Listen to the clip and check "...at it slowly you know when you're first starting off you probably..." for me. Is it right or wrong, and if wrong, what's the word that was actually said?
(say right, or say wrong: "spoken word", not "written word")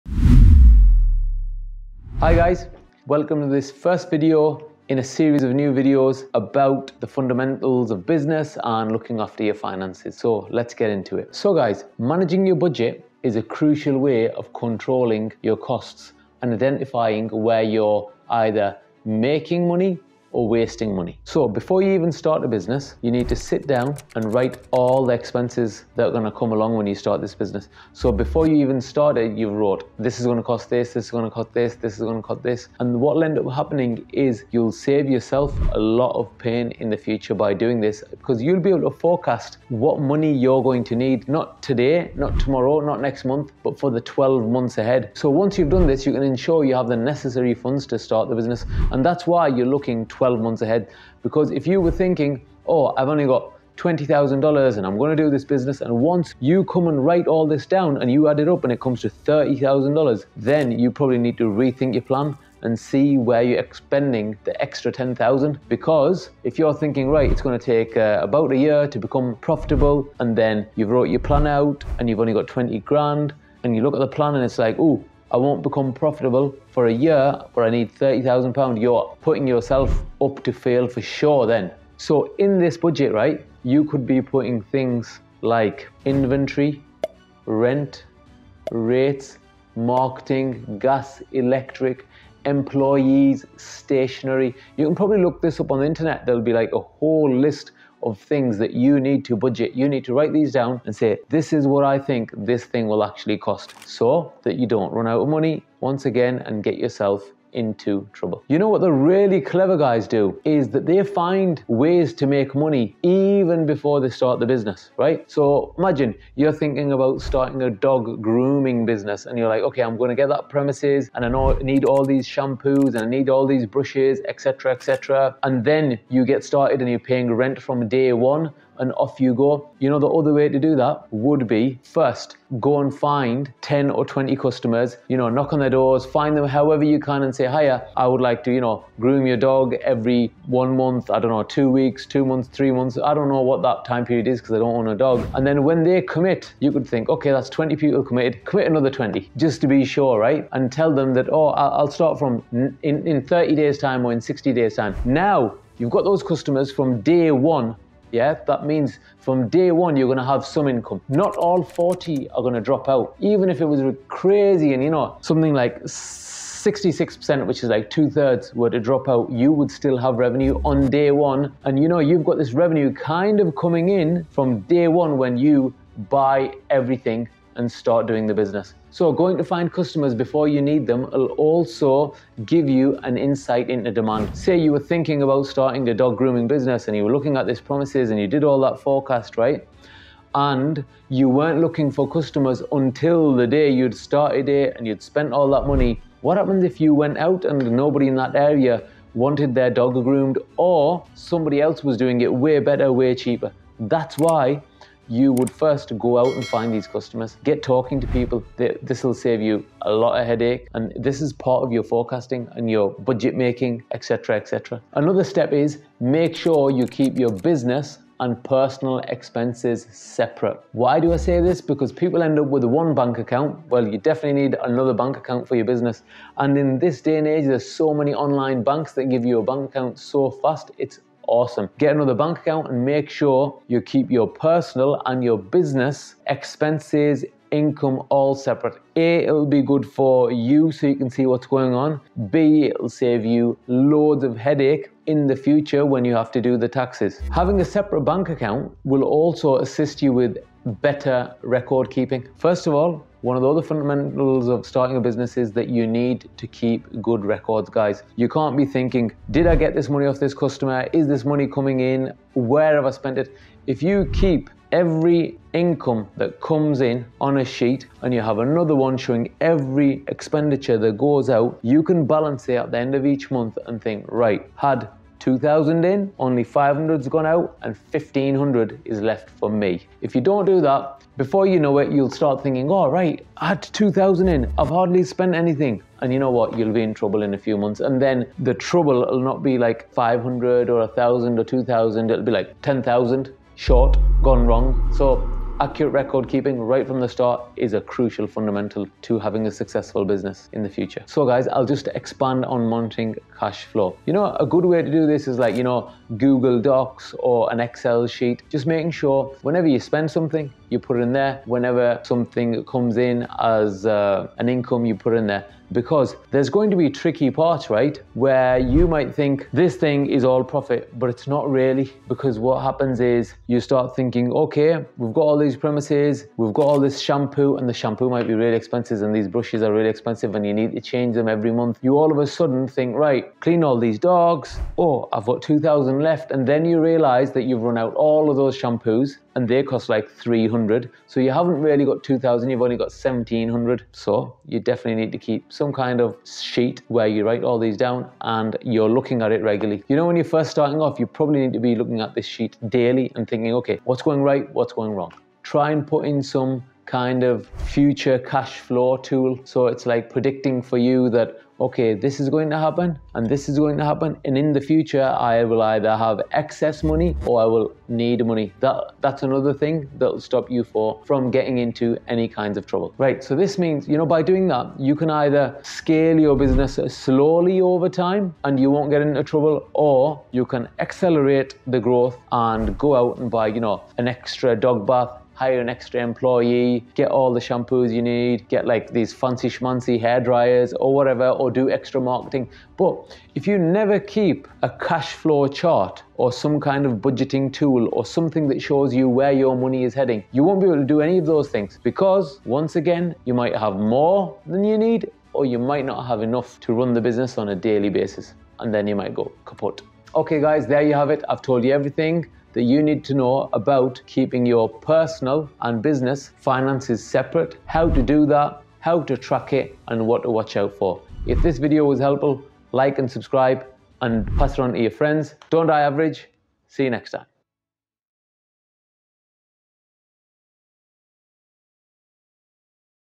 wrong: "regularly", not "slowly".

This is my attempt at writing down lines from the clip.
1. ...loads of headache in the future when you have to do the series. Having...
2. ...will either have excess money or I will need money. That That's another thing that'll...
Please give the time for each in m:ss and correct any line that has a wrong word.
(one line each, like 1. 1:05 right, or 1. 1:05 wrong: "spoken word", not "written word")
1. 4:03 wrong: "taxes", not "series"
2. 6:05 right.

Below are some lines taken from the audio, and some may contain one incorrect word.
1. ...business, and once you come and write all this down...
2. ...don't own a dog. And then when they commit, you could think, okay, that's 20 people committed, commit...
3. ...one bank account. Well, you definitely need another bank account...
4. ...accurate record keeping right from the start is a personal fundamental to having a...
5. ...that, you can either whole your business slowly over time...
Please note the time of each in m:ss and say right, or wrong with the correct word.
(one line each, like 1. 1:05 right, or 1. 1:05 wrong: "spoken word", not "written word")
1. 0:55 right
2. 2:24 right
3. 3:42 right
4. 4:55 wrong: "crucial", not "personal"
5. 6:14 wrong: "scale", not "whole".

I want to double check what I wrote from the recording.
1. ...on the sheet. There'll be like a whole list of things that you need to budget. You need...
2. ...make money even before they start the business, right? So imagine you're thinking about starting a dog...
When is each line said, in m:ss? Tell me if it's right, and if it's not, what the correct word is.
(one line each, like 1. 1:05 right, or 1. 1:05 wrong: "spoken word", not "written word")
1. 1:35 wrong: "internet", not "sheet"
2. 1:52 right.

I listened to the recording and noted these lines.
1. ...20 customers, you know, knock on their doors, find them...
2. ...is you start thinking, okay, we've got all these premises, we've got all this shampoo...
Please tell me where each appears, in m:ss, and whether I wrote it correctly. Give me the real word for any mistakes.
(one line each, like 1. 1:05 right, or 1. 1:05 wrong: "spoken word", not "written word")
1. 2:14 right
2. 5:22 right.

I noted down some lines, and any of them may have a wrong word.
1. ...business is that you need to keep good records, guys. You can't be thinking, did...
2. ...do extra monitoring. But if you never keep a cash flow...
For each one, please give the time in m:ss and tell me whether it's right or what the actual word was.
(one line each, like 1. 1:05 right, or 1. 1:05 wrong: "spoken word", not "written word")
1. 4:15 right
2. 6:31 wrong: "marketing", not "monitoring".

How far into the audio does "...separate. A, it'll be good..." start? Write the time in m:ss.
3:58.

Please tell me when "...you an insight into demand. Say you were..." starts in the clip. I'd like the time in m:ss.
3:02.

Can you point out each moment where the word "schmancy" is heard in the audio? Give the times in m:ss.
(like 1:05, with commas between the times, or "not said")
6:29.